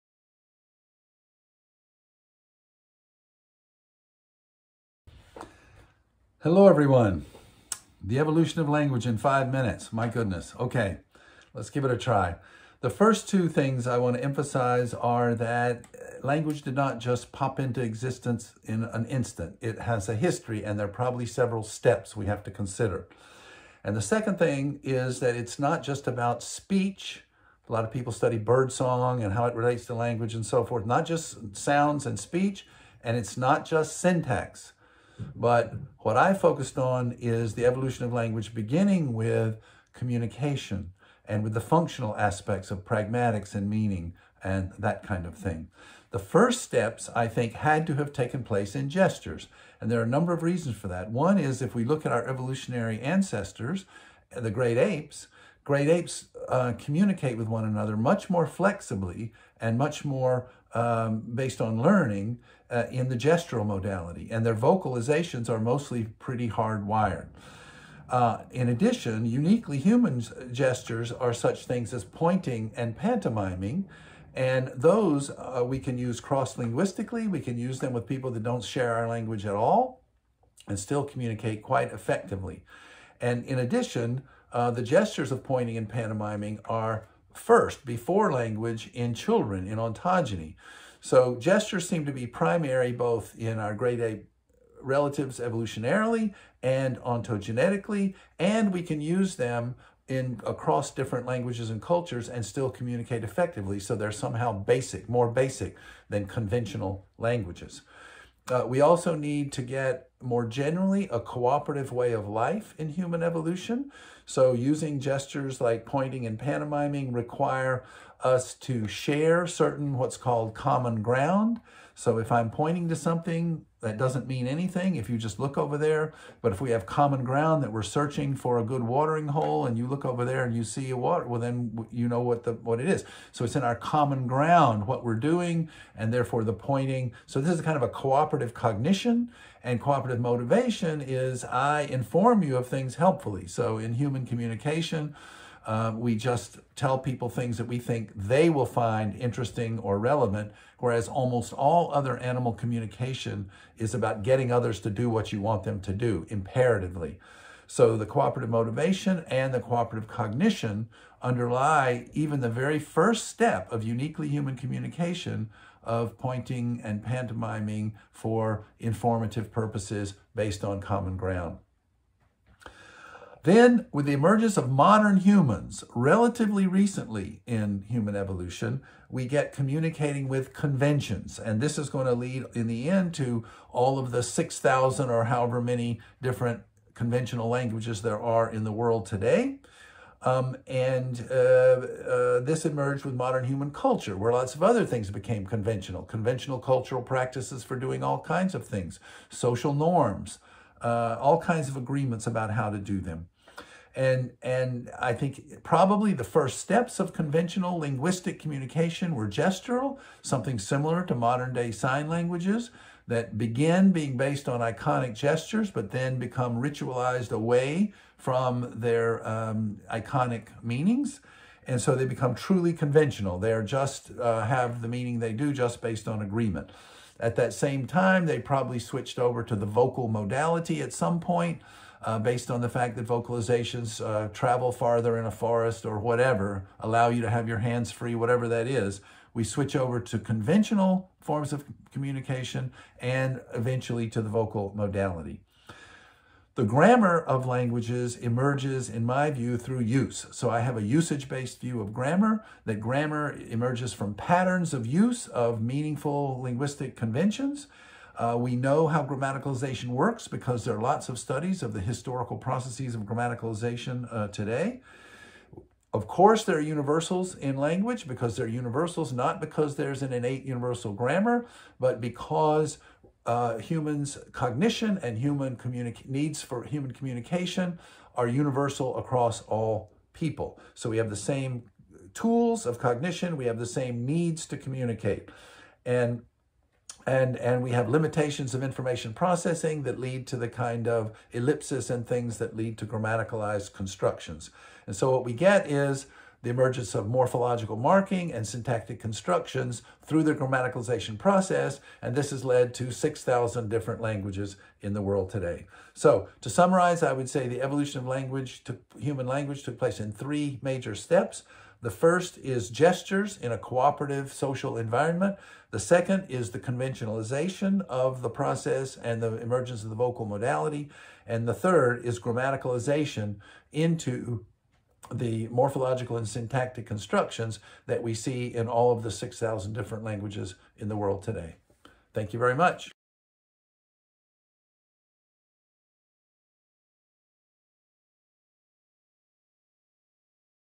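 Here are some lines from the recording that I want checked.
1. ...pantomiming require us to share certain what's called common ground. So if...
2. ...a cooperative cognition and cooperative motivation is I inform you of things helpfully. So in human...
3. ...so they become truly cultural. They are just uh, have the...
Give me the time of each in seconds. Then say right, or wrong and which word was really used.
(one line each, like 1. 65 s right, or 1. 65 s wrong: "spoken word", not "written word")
1. 116 s right
2. 137 s right
3. 221 s wrong: "conventional", not "cultural".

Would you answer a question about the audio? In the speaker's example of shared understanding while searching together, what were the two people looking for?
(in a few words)
a good watering hole.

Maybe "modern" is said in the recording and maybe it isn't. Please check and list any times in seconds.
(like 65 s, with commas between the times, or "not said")
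174 s, 193 s, 211 s.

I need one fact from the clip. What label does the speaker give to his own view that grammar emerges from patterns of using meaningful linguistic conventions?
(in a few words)
usage-based view.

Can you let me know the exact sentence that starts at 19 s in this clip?
It has a history, and there are probably several steps we have to consider.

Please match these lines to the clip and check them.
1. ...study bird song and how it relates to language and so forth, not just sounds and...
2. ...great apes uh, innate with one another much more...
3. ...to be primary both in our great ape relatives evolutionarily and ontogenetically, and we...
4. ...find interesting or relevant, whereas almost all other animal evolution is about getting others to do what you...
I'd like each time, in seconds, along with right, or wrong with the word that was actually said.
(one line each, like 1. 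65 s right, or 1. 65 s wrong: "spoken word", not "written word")
1. 28 s right
2. 55 s wrong: "communicate", not "innate"
3. 92 s right
4. 148 s wrong: "communication", not "evolution".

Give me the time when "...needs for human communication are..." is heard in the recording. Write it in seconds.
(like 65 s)
276 s.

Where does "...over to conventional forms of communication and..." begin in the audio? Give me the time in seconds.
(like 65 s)
239 s.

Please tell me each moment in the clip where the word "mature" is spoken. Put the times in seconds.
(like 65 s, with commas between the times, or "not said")
not said.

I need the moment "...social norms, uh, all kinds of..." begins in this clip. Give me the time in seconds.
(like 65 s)
199 s.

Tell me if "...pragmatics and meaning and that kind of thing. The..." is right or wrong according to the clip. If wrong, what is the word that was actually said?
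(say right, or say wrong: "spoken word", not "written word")
right.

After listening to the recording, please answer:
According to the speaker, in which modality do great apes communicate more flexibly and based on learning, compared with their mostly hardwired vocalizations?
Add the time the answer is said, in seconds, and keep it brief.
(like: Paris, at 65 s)
gestural modality, at 63 s.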